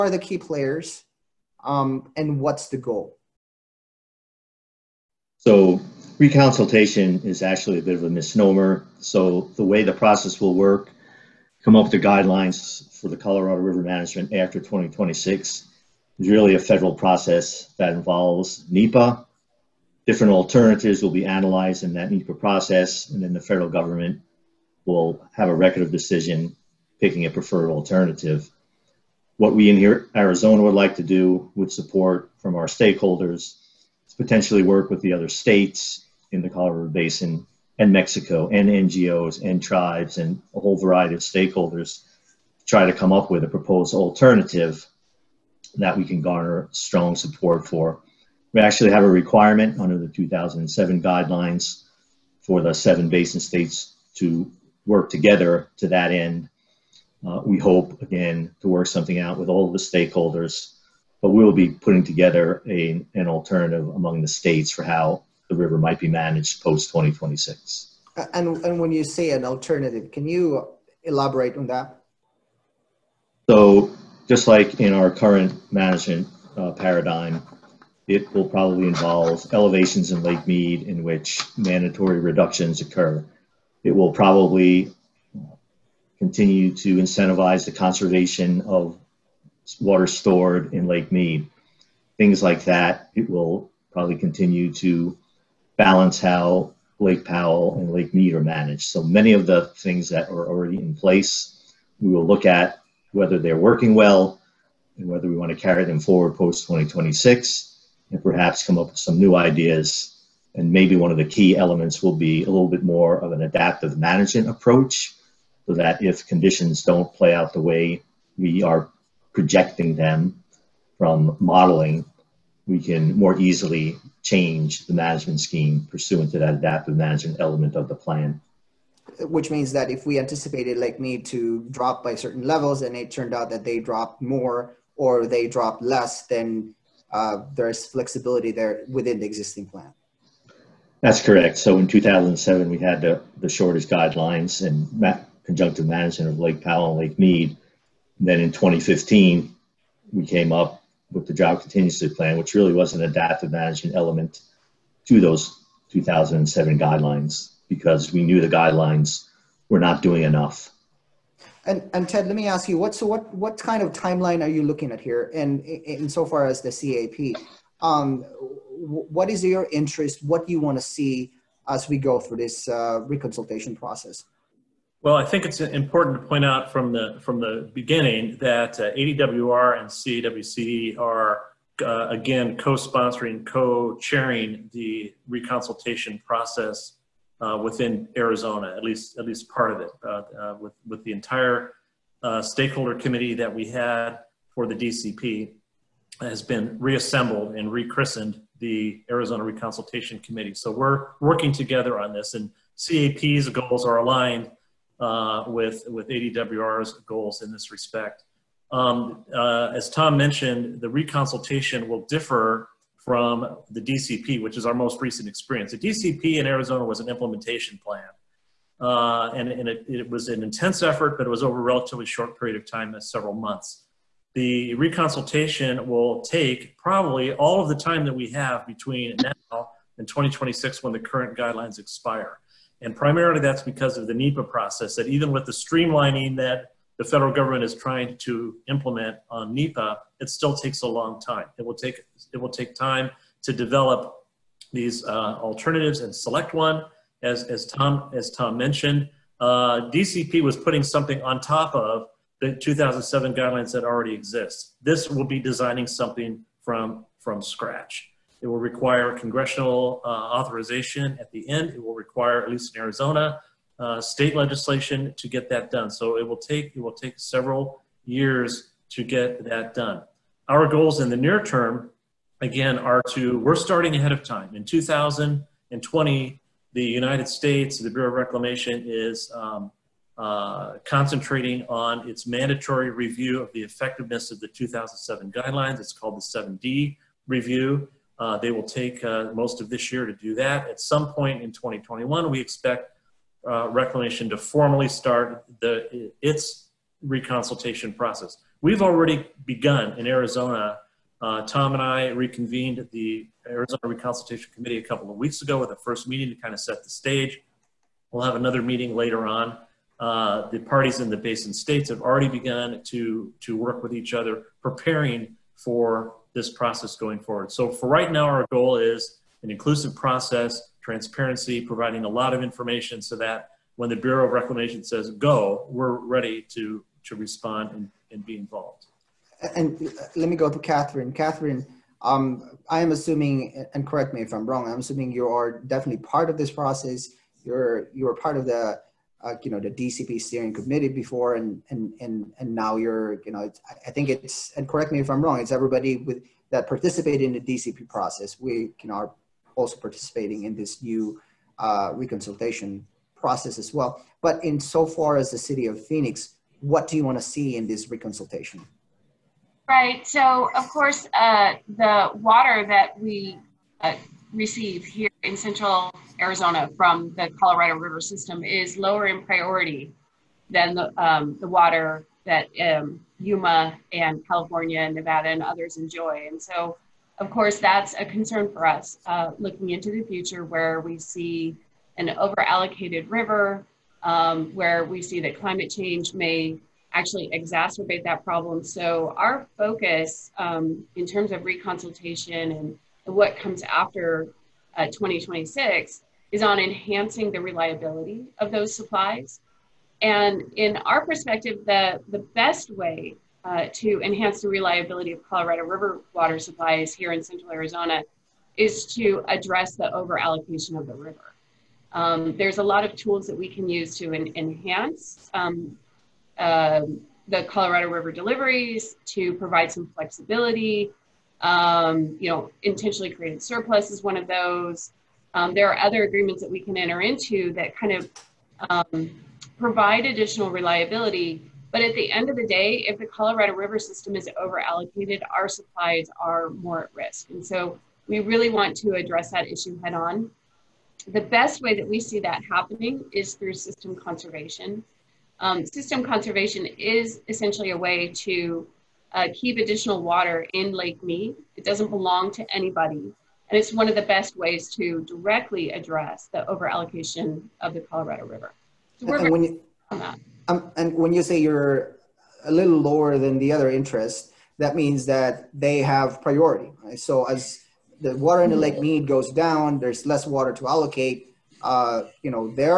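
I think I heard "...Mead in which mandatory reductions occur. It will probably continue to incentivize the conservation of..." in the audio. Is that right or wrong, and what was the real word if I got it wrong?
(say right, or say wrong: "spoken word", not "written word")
right.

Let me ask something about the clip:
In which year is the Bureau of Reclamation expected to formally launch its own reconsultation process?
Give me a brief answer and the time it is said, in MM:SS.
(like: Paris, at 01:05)
2021, at 04:51.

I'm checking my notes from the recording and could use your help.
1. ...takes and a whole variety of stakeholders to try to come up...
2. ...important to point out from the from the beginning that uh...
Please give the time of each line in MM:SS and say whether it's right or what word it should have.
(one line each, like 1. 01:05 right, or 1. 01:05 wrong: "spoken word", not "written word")
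1. 00:39 wrong: "tribes", not "takes"
2. 02:55 right.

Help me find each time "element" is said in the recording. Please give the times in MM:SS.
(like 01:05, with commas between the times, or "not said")
01:51, 02:07, 02:33.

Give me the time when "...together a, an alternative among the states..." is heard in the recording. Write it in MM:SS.
01:02.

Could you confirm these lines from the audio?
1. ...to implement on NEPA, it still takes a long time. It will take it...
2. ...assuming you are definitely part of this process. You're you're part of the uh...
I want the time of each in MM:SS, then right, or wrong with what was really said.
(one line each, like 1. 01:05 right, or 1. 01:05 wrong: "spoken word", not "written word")
1. 03:58 right
2. 05:34 right.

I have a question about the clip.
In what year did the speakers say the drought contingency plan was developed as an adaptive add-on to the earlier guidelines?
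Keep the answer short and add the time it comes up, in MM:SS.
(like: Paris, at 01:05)
2015, at 02:28.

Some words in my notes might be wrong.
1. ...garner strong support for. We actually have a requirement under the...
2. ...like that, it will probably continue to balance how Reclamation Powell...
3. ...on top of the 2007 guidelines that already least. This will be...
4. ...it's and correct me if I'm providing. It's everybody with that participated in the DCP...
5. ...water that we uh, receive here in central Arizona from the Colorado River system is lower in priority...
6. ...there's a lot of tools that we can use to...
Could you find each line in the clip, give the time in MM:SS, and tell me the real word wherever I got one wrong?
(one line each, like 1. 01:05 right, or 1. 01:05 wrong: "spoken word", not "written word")
1. 00:46 right
2. 01:32 wrong: "Lake", not "Reclamation"
3. 04:11 wrong: "exist", not "least"
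4. 05:44 wrong: "wrong", not "providing"
5. 06:02 right
6. 06:52 right.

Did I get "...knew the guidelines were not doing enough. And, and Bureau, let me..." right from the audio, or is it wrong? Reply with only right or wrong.
wrong.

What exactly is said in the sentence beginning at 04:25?
So it will take it will take several years to get that done.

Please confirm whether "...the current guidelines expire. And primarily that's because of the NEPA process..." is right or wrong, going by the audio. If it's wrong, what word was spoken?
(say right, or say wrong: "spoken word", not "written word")
right.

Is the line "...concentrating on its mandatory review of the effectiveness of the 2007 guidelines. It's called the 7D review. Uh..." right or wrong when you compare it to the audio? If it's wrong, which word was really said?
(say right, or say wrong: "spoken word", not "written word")
right.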